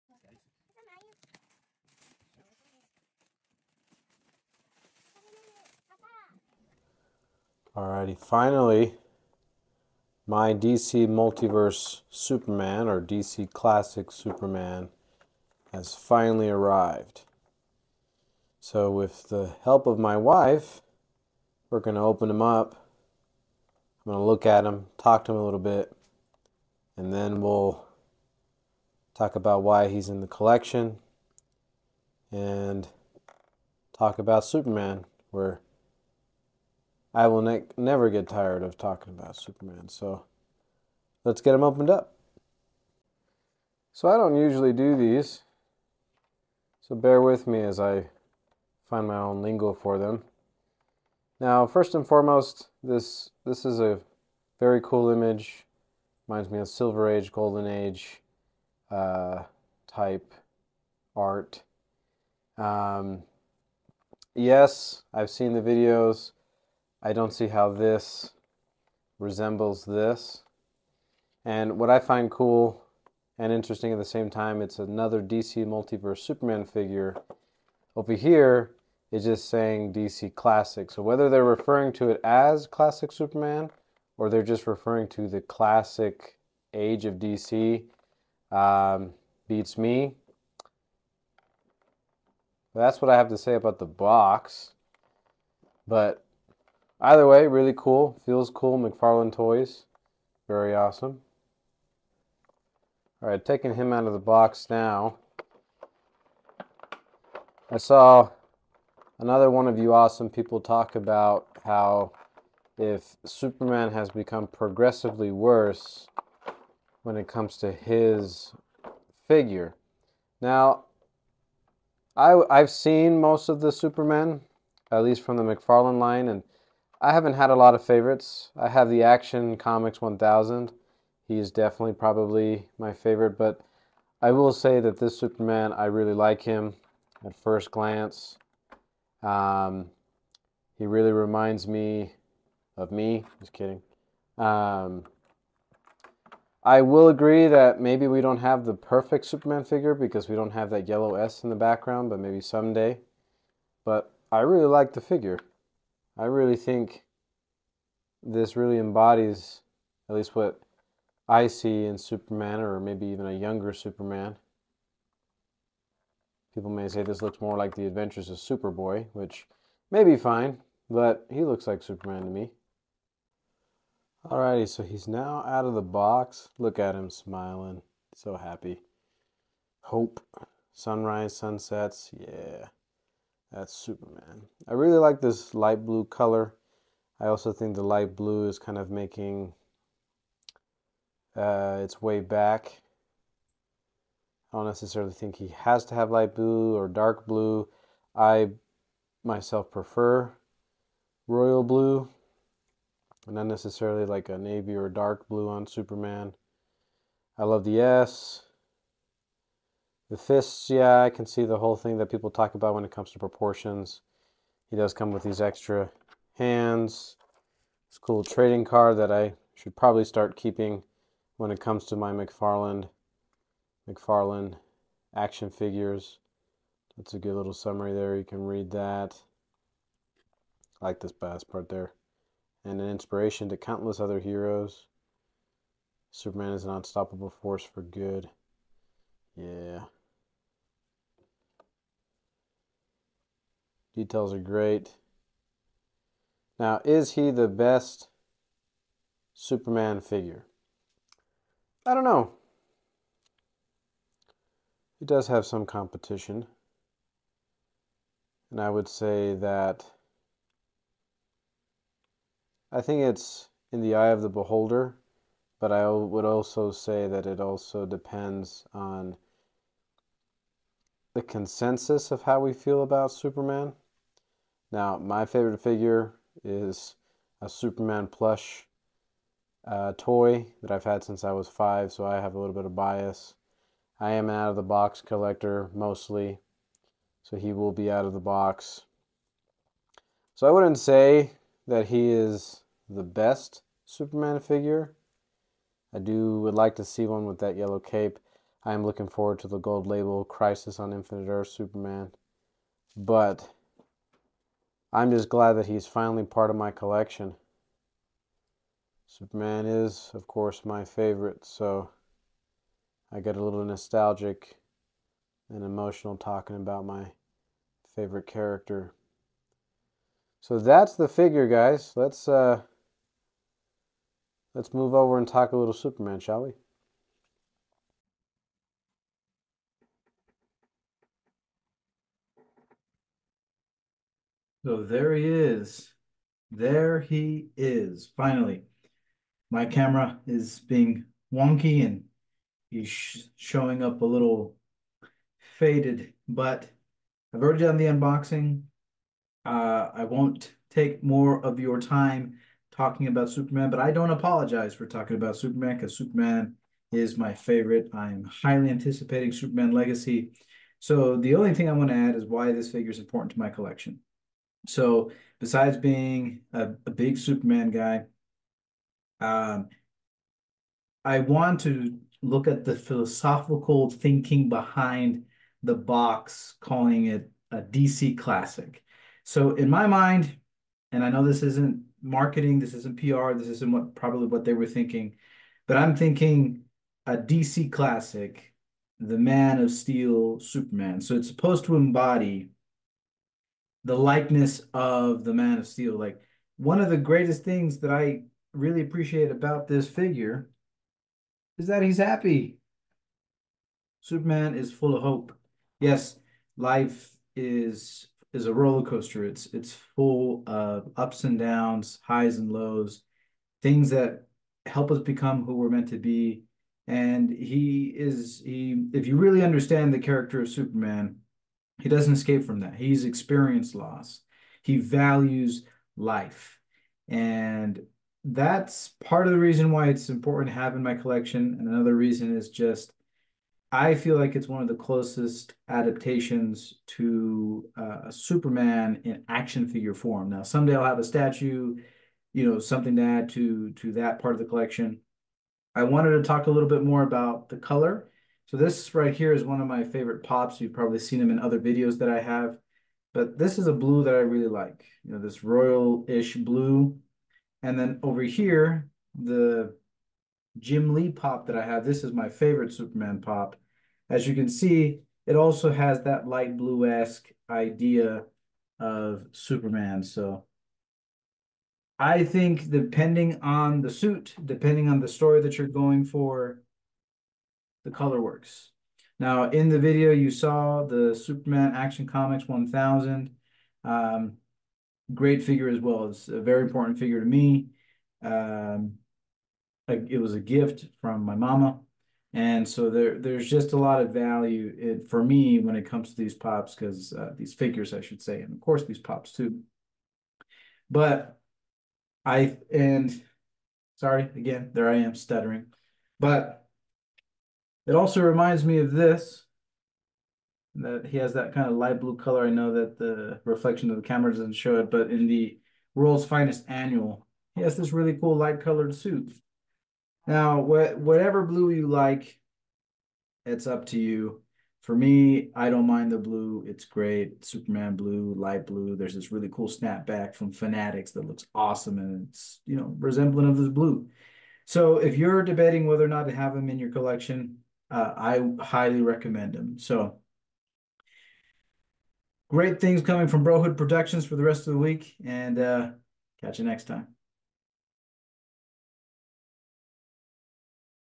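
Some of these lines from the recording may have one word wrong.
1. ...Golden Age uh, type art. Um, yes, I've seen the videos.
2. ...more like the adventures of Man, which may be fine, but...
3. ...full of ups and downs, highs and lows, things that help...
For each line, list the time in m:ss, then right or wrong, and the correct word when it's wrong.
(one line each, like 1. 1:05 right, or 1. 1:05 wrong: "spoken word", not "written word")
1. 0:57 right
2. 2:47 wrong: "Superboy", not "Man"
3. 6:49 right.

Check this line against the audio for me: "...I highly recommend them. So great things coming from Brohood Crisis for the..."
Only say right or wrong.
wrong.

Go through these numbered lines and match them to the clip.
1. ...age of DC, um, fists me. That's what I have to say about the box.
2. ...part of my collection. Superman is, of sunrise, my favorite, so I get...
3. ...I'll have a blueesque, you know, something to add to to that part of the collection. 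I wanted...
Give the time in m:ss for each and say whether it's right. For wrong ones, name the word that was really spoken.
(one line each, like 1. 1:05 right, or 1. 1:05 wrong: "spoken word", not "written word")
1. 1:26 wrong: "beats", not "fists"
2. 5:06 wrong: "course", not "sunrise"
3. 7:20 wrong: "statue", not "blueesque".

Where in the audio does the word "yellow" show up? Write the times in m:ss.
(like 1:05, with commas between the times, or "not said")
2:30, 4:57.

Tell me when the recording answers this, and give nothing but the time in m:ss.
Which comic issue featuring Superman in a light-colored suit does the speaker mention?
8:35.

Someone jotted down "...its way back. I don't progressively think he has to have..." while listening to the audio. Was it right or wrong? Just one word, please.
wrong.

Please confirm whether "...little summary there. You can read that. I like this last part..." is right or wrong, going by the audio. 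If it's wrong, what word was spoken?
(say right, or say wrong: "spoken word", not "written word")
right.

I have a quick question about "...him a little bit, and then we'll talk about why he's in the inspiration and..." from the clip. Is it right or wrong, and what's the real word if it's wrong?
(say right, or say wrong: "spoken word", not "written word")
wrong: "collection", not "inspiration".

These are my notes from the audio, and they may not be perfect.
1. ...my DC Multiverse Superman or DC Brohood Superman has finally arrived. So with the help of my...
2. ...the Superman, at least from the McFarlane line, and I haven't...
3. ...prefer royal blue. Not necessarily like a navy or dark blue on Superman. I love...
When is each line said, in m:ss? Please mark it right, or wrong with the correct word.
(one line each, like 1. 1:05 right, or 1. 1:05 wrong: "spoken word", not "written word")
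1. 0:10 wrong: "Classic", not "Brohood"
2. 2:03 right
3. 3:19 right.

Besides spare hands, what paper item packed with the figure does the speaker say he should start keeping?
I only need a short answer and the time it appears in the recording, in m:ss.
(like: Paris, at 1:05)
Trading card, at 3:38.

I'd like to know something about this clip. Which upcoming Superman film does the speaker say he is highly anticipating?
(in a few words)
Superman Legacy.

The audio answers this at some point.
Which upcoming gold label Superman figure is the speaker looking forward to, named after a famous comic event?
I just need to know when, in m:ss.
5:00.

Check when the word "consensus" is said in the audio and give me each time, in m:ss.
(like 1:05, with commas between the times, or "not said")
4:31.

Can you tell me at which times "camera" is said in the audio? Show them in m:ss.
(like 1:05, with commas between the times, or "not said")
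5:39, 8:34.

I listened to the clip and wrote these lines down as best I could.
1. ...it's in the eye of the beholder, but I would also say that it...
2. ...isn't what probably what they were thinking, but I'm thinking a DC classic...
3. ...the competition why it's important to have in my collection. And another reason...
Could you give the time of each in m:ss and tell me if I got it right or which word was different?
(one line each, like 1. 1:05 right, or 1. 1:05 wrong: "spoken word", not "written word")
1. 4:23 right
2. 6:23 right
3. 7:09 wrong: "reason", not "competition".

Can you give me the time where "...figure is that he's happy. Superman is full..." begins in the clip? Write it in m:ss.
6:39.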